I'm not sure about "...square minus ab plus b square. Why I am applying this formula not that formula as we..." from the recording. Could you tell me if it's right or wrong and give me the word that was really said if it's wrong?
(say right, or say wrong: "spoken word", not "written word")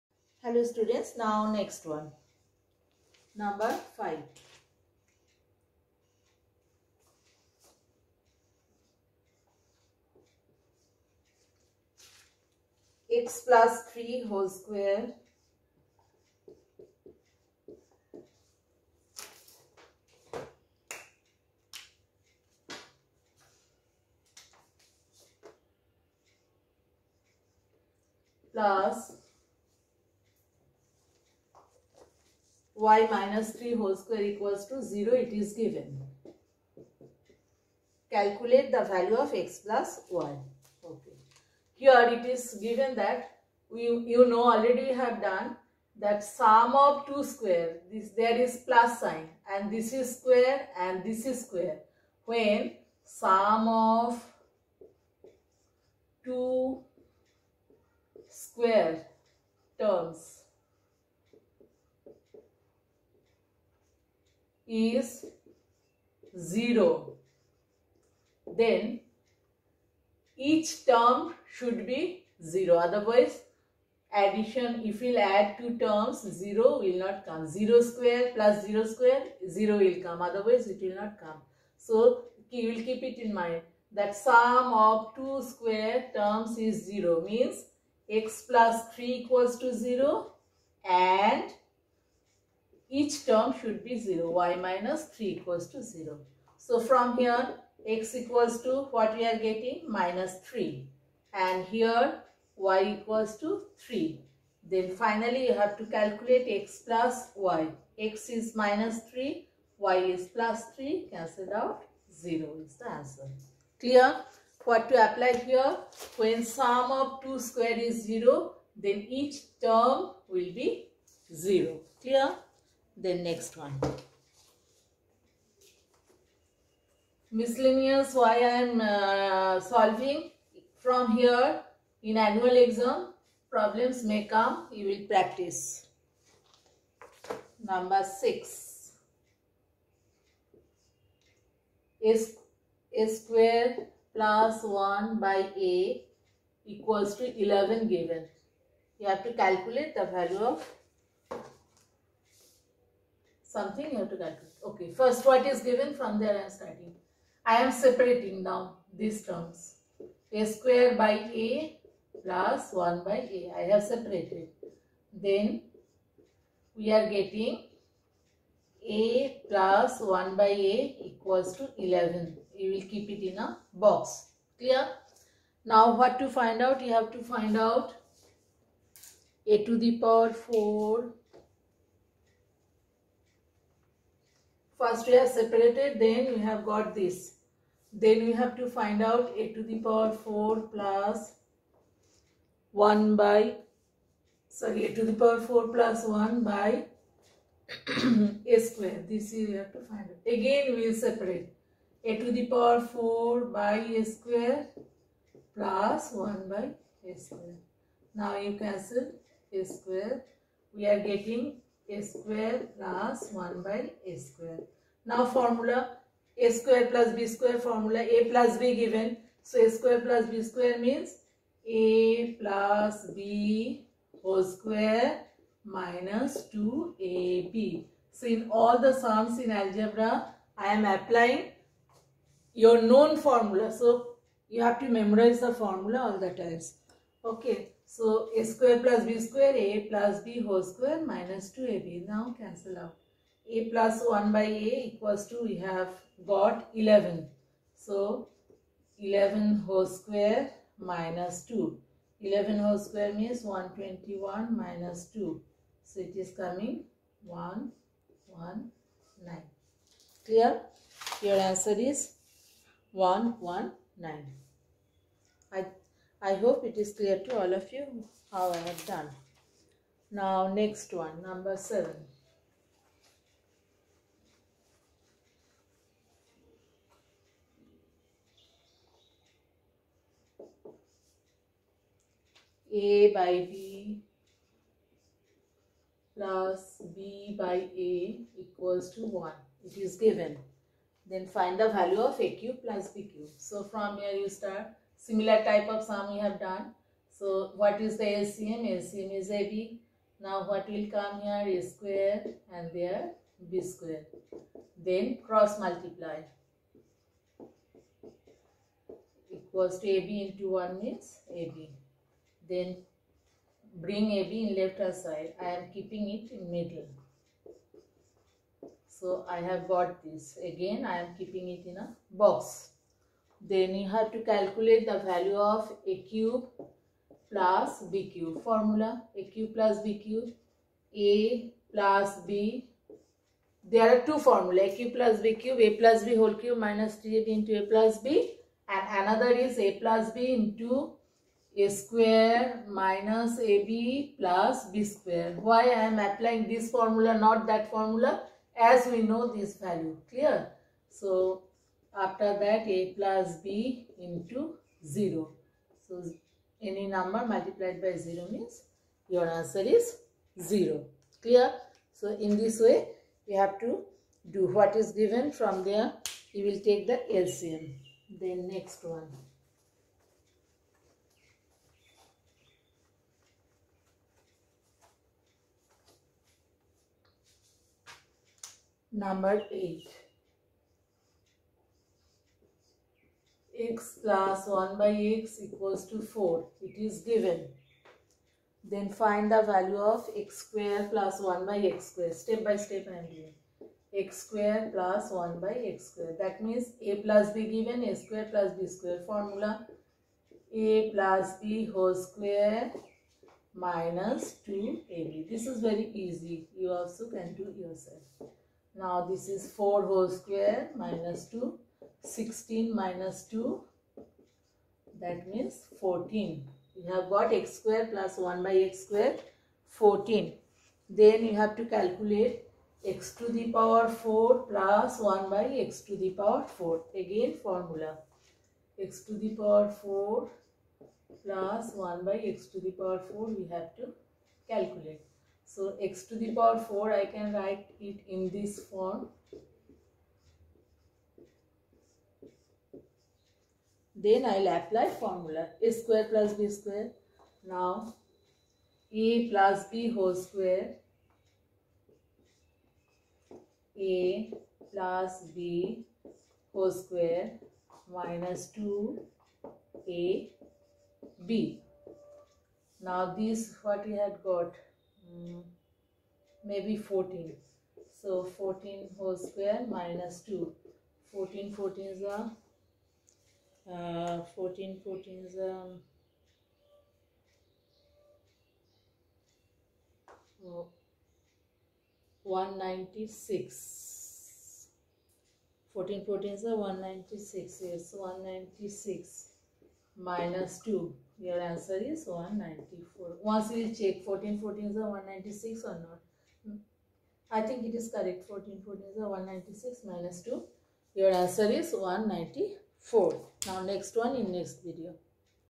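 right.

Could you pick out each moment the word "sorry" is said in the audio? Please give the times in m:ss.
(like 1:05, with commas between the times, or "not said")
3:14.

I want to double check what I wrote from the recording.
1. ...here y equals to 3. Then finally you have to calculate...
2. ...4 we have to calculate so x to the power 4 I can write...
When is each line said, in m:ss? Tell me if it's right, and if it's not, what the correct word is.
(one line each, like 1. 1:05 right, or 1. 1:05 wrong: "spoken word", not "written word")
1. 1:41 right
2. 7:13 right.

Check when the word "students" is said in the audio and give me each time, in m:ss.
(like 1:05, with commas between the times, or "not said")
0:00.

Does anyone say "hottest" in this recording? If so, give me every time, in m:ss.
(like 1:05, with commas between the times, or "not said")
not said.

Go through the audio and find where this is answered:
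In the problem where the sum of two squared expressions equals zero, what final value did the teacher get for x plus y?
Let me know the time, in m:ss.
1:51.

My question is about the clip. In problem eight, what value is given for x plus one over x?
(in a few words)
4.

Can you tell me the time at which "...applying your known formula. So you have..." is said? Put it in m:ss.
3:50.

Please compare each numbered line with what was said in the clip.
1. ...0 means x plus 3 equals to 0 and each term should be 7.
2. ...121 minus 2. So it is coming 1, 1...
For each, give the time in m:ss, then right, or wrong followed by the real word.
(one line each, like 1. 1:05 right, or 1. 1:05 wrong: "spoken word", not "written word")
1. 1:26 wrong: "0", not "7"
2. 4:13 right.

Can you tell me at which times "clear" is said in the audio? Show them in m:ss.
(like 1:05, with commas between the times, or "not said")
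1:53, 2:02, 2:54, 4:20, 4:26, 5:50, 6:01.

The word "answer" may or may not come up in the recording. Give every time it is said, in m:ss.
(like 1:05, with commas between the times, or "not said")
1:52, 4:21, 5:59, 8:11, 8:21.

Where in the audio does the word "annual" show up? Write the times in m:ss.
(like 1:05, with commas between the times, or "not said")
2:12.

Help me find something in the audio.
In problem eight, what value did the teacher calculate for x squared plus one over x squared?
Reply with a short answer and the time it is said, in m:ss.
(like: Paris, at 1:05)
14, at 6:52.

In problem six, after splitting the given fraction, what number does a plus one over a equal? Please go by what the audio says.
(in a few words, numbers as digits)
11.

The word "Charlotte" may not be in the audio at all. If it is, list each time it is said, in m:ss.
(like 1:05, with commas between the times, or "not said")
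not said.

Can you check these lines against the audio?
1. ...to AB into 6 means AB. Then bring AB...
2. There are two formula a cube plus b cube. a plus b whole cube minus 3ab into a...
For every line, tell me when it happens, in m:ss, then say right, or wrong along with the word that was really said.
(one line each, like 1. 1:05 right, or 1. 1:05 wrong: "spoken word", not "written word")
1. 5:09 wrong: "1", not "6"
2. 5:33 right.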